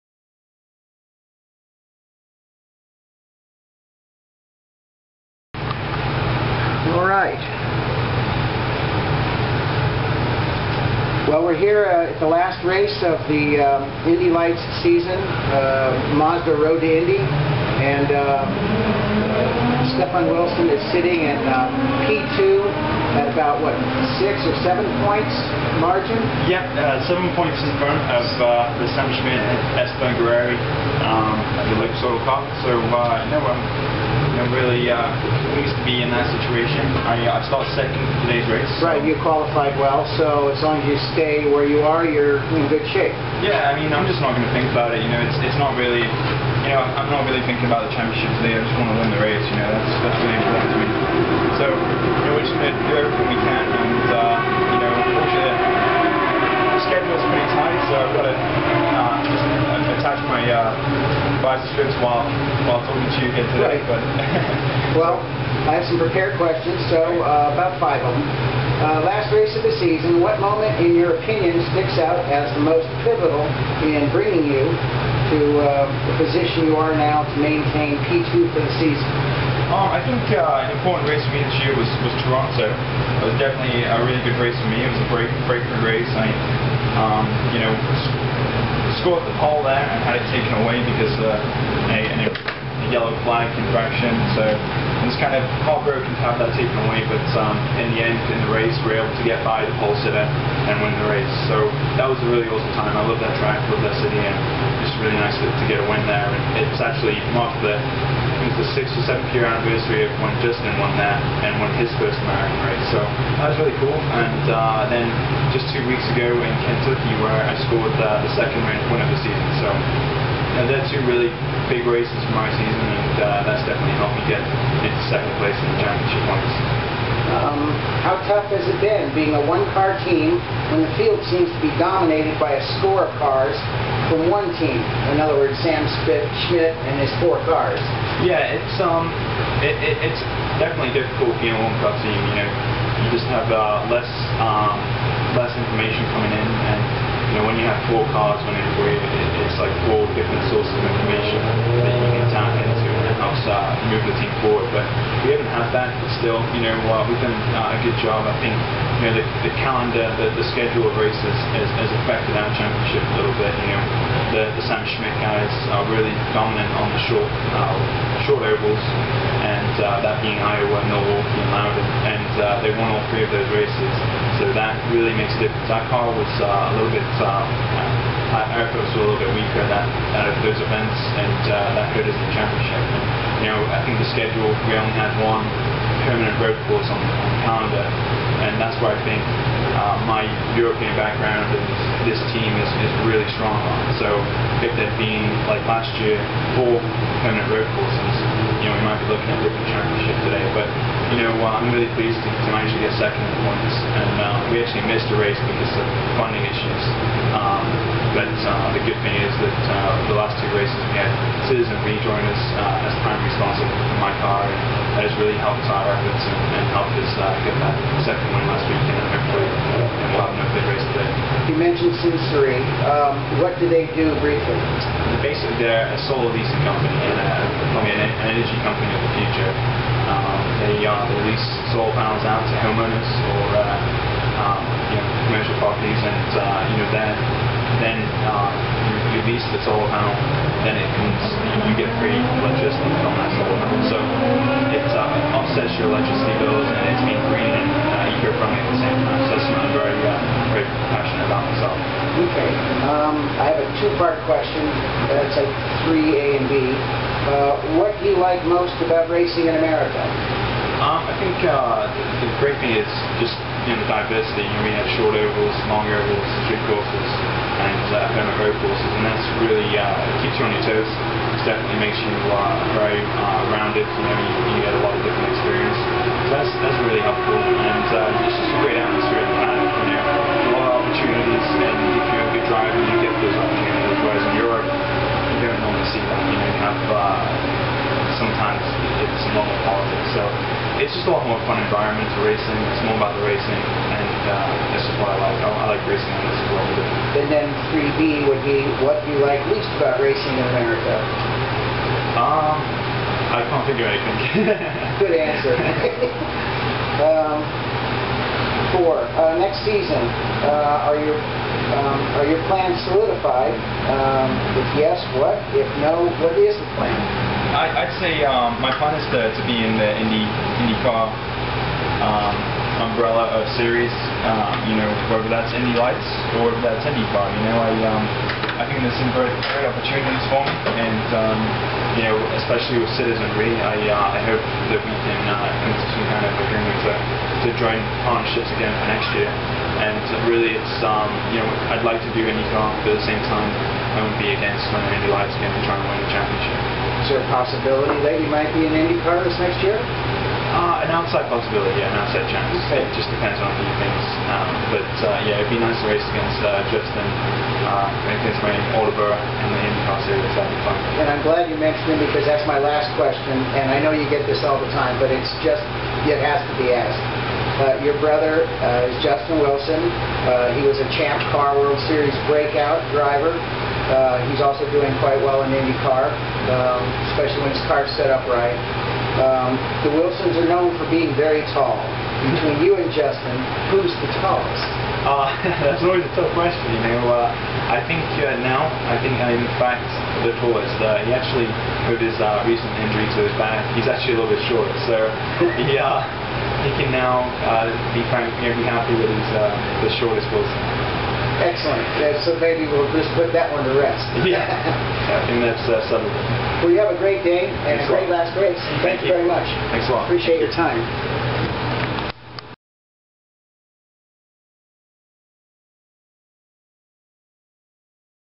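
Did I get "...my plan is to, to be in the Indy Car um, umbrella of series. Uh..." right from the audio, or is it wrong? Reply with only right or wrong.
wrong.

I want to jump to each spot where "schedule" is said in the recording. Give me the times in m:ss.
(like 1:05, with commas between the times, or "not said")
2:40, 3:04.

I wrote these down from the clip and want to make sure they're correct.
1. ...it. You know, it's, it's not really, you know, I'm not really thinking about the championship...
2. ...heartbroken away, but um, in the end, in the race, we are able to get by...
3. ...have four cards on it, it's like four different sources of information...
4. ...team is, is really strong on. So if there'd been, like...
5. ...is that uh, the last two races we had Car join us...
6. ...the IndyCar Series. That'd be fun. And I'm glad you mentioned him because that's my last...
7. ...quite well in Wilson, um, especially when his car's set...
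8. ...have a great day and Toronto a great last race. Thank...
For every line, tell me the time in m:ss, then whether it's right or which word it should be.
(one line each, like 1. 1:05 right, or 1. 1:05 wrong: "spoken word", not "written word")
1. 0:44 right
2. 1:36 wrong: "taken", not "heartbroken"
3. 2:27 right
4. 3:12 right
5. 3:29 wrong: "Citizenre", not "Car"
6. 5:59 right
7. 6:14 wrong: "IndyCar", not "Wilson"
8. 6:46 wrong: "Thanks", not "Toronto".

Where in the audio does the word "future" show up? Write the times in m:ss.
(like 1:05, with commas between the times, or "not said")
3:49.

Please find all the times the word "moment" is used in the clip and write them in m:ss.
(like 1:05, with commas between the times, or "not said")
1:10.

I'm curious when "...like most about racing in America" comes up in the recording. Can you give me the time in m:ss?
4:18.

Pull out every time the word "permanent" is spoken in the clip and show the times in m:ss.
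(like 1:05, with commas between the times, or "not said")
3:06, 3:17.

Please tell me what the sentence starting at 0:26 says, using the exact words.
Yep, uh, seven points in front of uh, the Sam Schmidt, Esteban Guerrieri, um, the Lake Soto Cup.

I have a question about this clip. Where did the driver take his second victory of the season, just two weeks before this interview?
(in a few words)
Kentucky.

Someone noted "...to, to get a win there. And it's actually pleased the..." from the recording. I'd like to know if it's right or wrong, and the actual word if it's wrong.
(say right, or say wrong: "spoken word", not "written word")
wrong: "marked", not "pleased".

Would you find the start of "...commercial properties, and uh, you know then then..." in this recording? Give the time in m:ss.
3:55.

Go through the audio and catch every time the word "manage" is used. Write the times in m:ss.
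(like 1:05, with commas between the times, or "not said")
3:22.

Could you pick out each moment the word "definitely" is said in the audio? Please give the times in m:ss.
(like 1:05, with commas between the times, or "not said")
1:23, 2:03, 2:20, 4:31.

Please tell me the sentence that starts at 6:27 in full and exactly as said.
Uh, I think uh, now, I think I'm uh, in fact the tallest.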